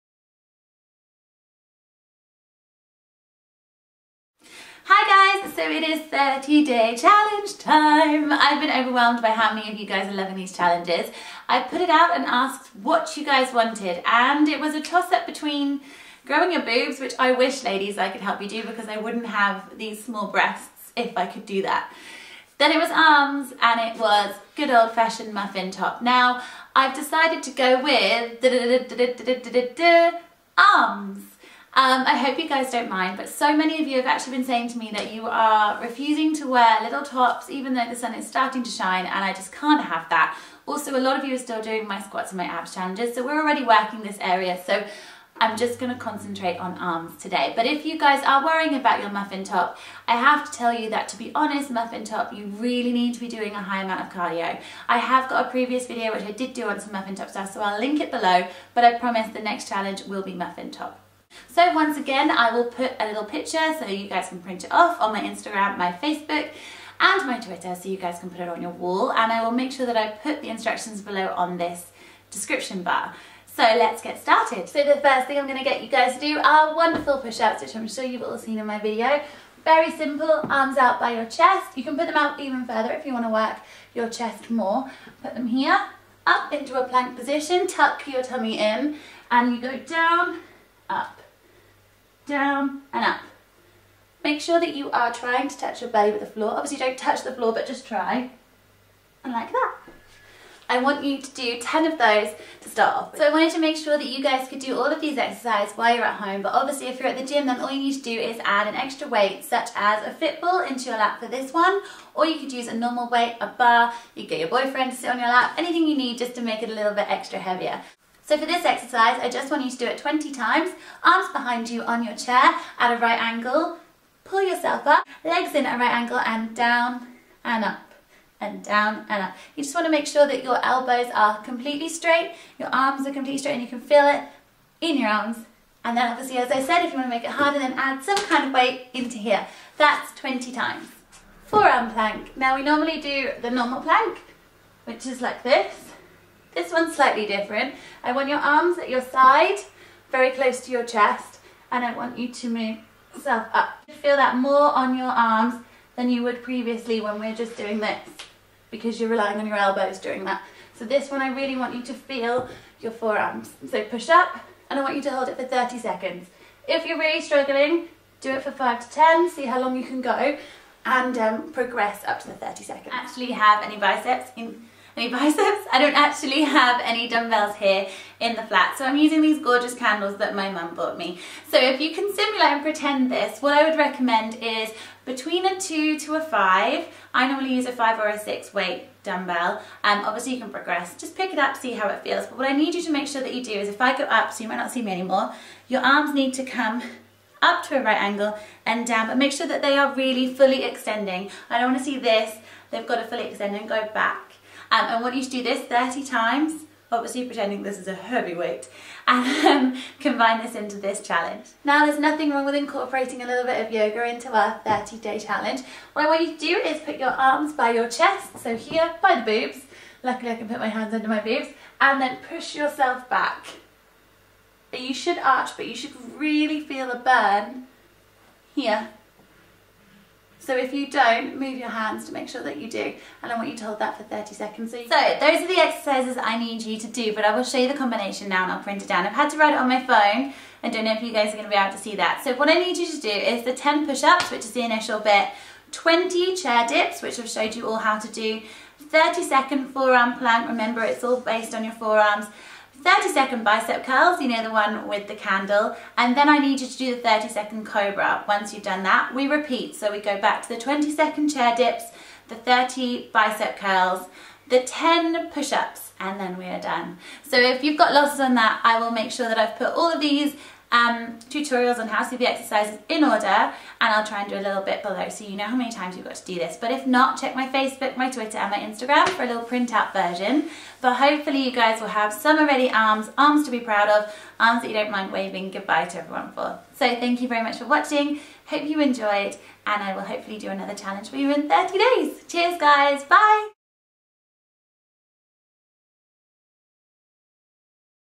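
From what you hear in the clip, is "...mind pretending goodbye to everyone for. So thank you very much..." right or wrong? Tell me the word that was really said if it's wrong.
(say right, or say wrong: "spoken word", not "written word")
wrong: "waving", not "pretending".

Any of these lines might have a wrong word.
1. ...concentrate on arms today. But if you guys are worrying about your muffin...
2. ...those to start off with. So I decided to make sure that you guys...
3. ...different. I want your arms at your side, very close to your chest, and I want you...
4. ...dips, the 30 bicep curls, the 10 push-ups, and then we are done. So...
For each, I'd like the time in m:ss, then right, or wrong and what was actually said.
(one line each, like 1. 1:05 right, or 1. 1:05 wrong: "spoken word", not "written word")
1. 0:45 right
2. 1:41 wrong: "wanted", not "decided"
3. 2:27 right
4. 4:21 right.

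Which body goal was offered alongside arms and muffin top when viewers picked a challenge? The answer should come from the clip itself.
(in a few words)
growing your boobs.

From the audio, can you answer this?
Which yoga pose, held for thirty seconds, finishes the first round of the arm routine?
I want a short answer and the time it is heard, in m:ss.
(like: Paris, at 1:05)
cobra, at 4:17.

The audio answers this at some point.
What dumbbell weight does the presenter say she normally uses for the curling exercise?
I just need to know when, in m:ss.
3:07.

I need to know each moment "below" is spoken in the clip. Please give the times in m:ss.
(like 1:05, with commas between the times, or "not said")
0:58, 1:11, 4:34.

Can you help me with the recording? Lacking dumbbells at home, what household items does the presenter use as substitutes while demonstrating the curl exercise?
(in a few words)
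candles.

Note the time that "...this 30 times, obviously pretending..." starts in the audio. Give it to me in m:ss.
3:25.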